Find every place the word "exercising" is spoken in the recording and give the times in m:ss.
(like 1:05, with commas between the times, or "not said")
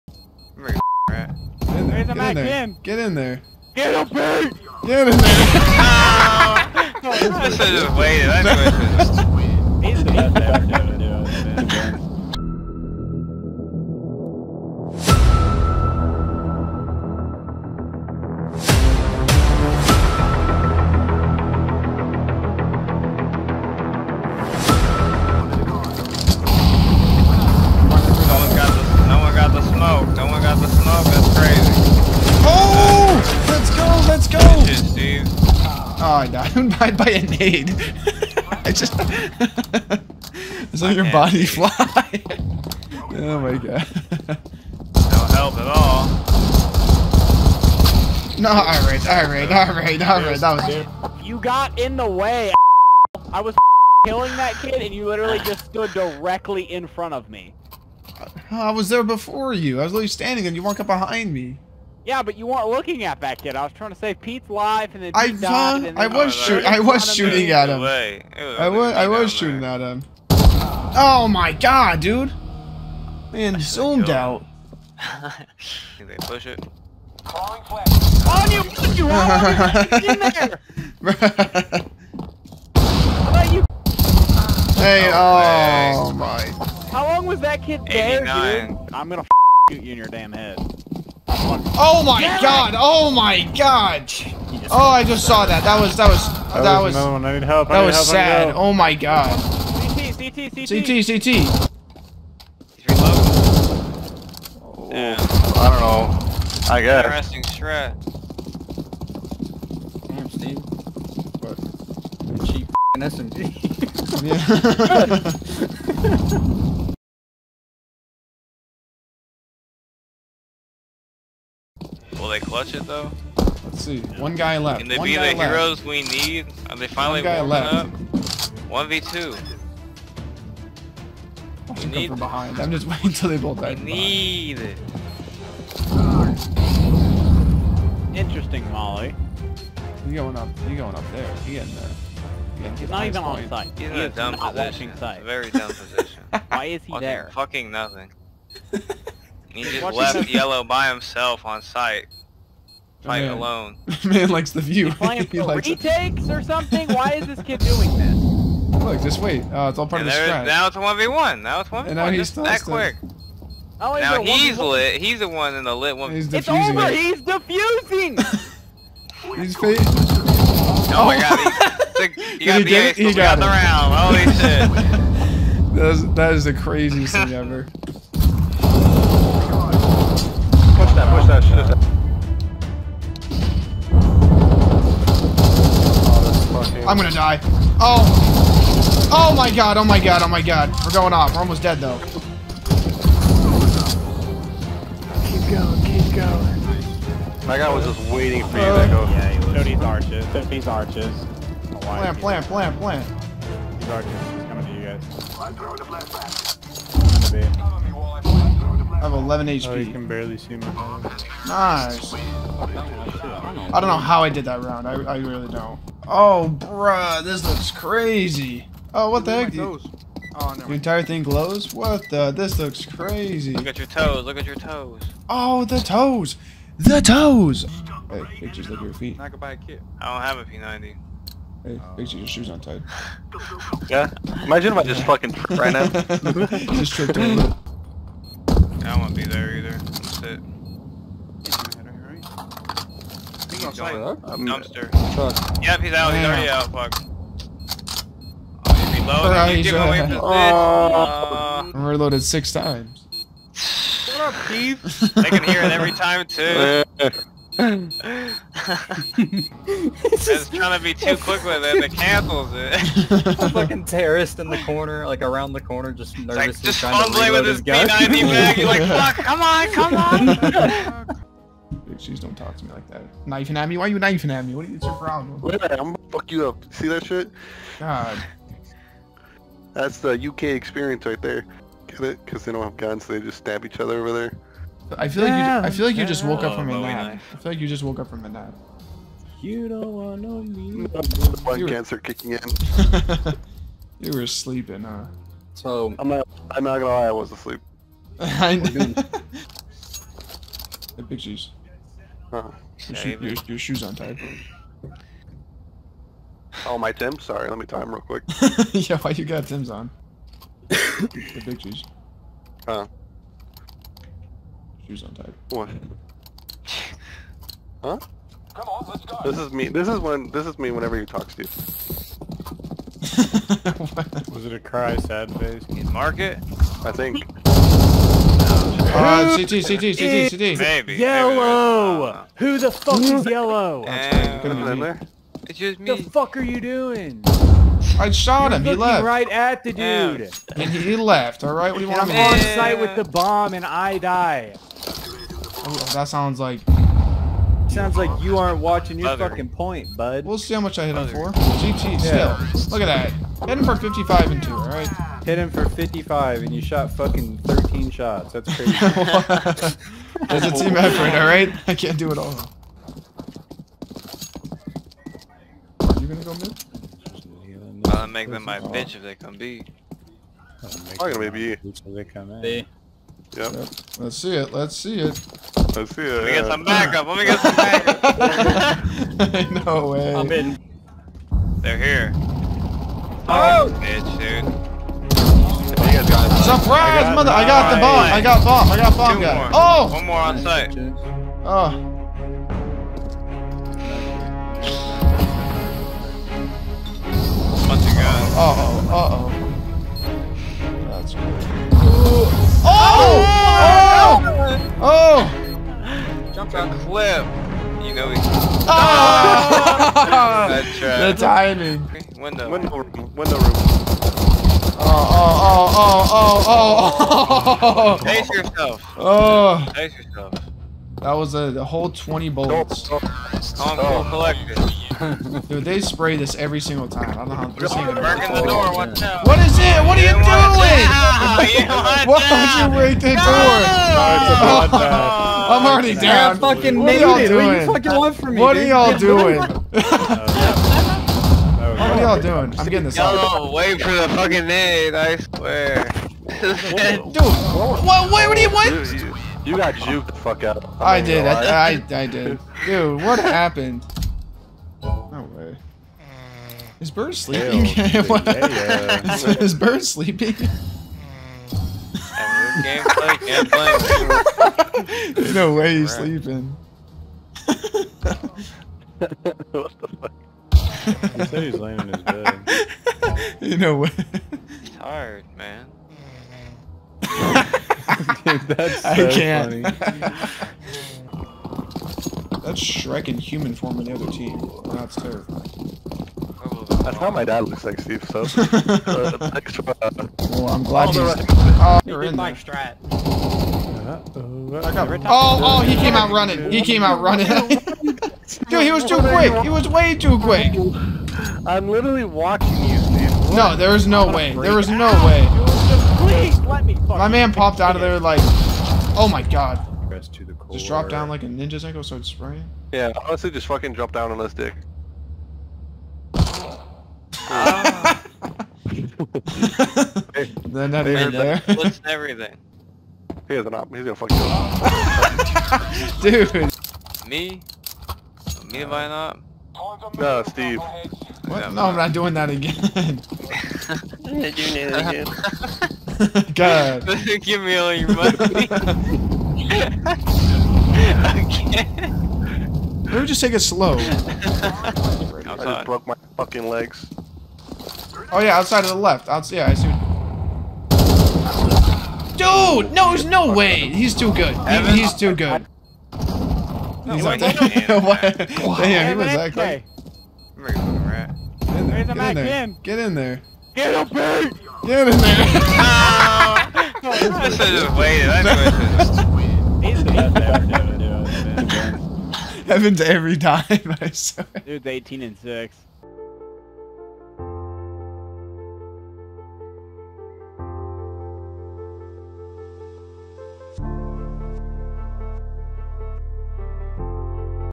not said.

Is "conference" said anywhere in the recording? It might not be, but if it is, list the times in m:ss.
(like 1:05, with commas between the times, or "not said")
not said.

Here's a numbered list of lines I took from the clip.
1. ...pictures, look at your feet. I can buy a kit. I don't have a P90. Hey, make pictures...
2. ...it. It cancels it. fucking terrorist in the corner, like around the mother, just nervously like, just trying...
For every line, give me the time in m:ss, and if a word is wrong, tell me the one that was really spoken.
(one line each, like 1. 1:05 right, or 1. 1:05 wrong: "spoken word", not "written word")
1. 3:48 right
2. 4:21 wrong: "corner", not "mother".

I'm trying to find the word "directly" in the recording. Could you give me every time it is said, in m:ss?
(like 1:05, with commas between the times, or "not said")
0:55.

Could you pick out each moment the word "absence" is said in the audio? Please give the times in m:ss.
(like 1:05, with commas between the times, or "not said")
not said.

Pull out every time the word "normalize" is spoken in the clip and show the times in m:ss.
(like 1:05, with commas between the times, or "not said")
not said.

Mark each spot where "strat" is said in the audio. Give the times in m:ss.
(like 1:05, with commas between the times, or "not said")
1:47, 2:40, 8:12.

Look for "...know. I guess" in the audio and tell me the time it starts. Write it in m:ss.
1:45.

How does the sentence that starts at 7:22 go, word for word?
I'm getting this Yo, wait for the fucking nade, I swear.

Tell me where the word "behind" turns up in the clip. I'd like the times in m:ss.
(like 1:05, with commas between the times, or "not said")
1:00, 2:12.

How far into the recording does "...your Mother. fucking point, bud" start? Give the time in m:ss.
5:48.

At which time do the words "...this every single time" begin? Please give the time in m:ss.
7:06.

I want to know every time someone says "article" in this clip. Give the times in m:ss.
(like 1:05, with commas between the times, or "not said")
not said.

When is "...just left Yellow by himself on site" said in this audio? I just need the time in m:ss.
2:29.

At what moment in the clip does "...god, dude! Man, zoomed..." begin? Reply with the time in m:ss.
1:11.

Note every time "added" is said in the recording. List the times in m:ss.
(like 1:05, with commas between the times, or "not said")
not said.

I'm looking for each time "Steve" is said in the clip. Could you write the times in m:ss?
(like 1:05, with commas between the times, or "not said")
1:50, 8:07, 8:50.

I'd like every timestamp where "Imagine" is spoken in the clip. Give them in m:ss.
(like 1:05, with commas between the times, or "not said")
3:54.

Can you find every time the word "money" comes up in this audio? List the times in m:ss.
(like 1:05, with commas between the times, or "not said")
8:57.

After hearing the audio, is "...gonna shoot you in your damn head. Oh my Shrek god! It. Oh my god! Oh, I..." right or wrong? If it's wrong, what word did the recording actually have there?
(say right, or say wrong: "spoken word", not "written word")
wrong: "Get", not "Shrek".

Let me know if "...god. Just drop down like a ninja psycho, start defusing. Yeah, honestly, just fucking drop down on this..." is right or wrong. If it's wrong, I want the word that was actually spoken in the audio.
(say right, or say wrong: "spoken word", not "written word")
wrong: "spraying", not "defusing".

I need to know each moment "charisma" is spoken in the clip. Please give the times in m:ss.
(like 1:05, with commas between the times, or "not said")
not said.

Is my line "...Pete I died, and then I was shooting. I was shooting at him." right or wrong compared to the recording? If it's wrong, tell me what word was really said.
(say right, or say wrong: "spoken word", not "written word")
right.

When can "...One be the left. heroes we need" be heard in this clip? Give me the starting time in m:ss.
2:04.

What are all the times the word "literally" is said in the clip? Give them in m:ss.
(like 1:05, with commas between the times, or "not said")
0:55, 0:59, 8:21.